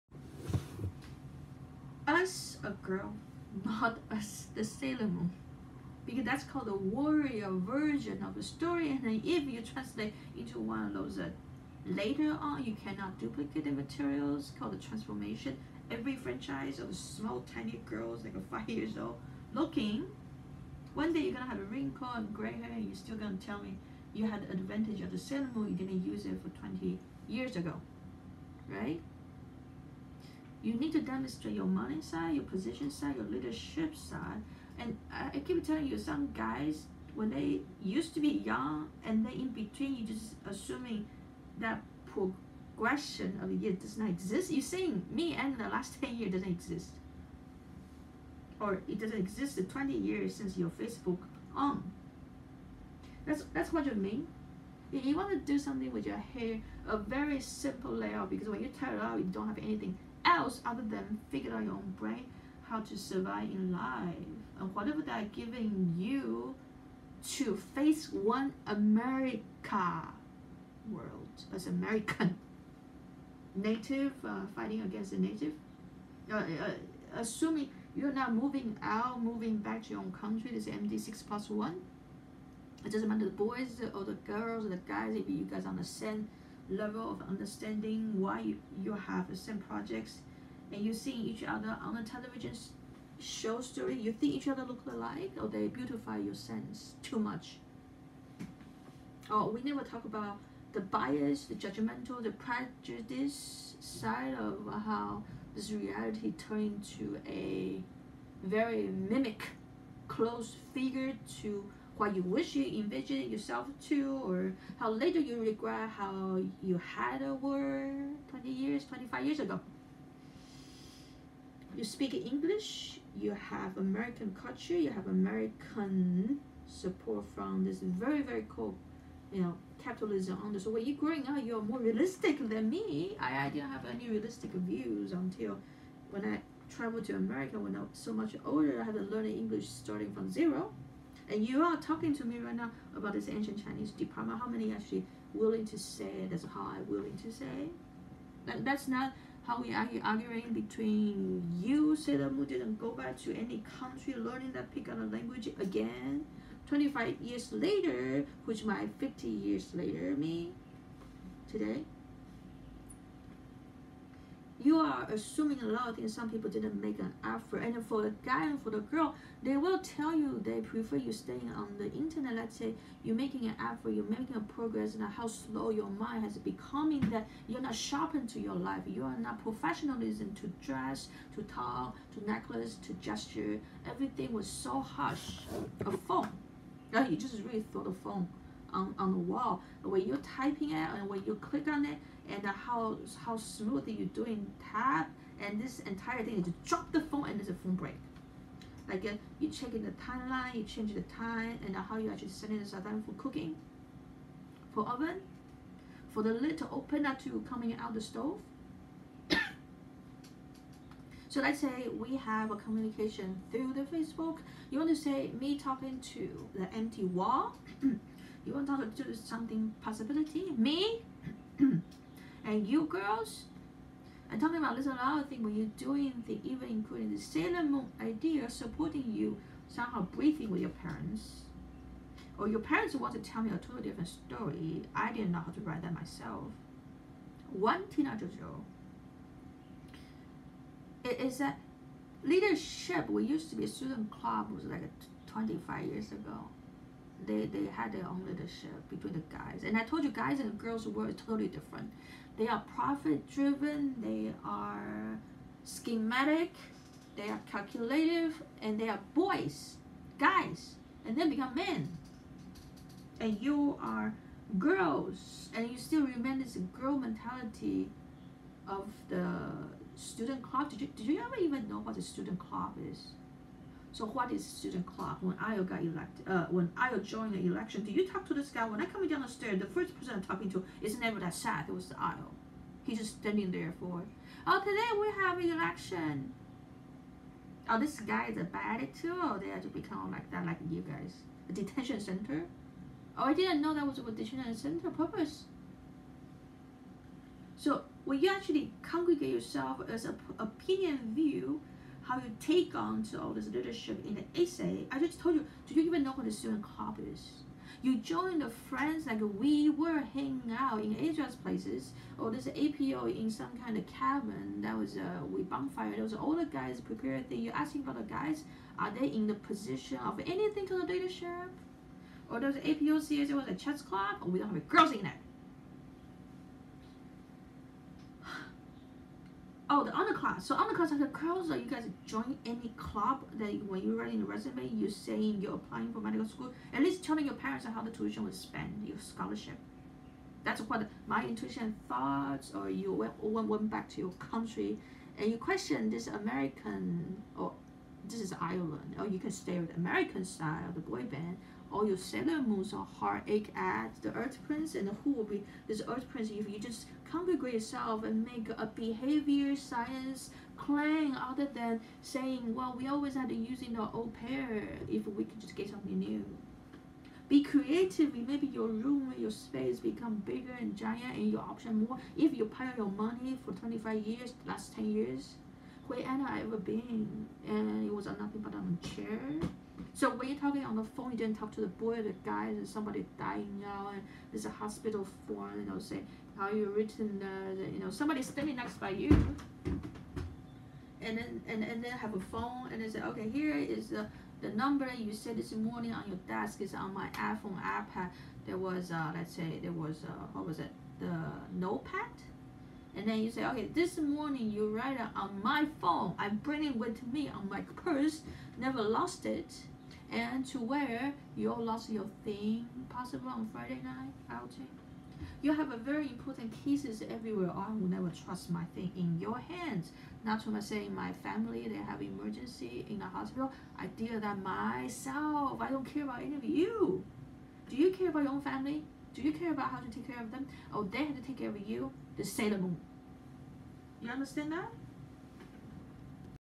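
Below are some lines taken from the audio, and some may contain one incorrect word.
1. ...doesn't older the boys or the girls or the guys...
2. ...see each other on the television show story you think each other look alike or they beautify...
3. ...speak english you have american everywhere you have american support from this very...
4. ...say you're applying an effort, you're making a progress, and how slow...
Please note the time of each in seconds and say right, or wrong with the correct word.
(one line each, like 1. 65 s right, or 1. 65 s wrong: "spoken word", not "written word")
1. 82 s wrong: "matter", not "older"
2. 90 s right
3. 121 s wrong: "culture", not "everywhere"
4. 172 s wrong: "making", not "applying".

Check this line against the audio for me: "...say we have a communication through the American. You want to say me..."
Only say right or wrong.
wrong.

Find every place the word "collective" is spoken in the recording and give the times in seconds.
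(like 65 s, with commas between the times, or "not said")
not said.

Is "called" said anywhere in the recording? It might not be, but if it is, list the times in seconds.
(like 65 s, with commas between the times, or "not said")
6 s, 14 s.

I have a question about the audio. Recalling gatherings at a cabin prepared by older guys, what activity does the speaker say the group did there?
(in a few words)
bonfire.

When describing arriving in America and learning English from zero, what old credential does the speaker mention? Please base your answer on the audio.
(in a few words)
ancient Chinese diploma.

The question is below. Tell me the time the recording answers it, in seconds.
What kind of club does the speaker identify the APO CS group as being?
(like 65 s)
323 s.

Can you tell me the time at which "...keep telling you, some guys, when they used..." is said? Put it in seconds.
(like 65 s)
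35 s.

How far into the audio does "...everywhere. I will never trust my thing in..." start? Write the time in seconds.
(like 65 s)
417 s.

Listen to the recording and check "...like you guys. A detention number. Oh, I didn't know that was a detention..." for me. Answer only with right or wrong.
wrong.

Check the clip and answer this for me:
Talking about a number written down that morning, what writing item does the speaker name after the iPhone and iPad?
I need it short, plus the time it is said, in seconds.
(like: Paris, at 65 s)
notepad, at 401 s.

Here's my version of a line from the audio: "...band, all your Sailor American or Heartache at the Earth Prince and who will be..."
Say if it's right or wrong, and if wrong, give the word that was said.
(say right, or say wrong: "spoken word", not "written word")
wrong: "Moons", not "American".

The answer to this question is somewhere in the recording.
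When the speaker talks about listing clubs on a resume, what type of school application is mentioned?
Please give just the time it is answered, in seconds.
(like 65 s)
335 s.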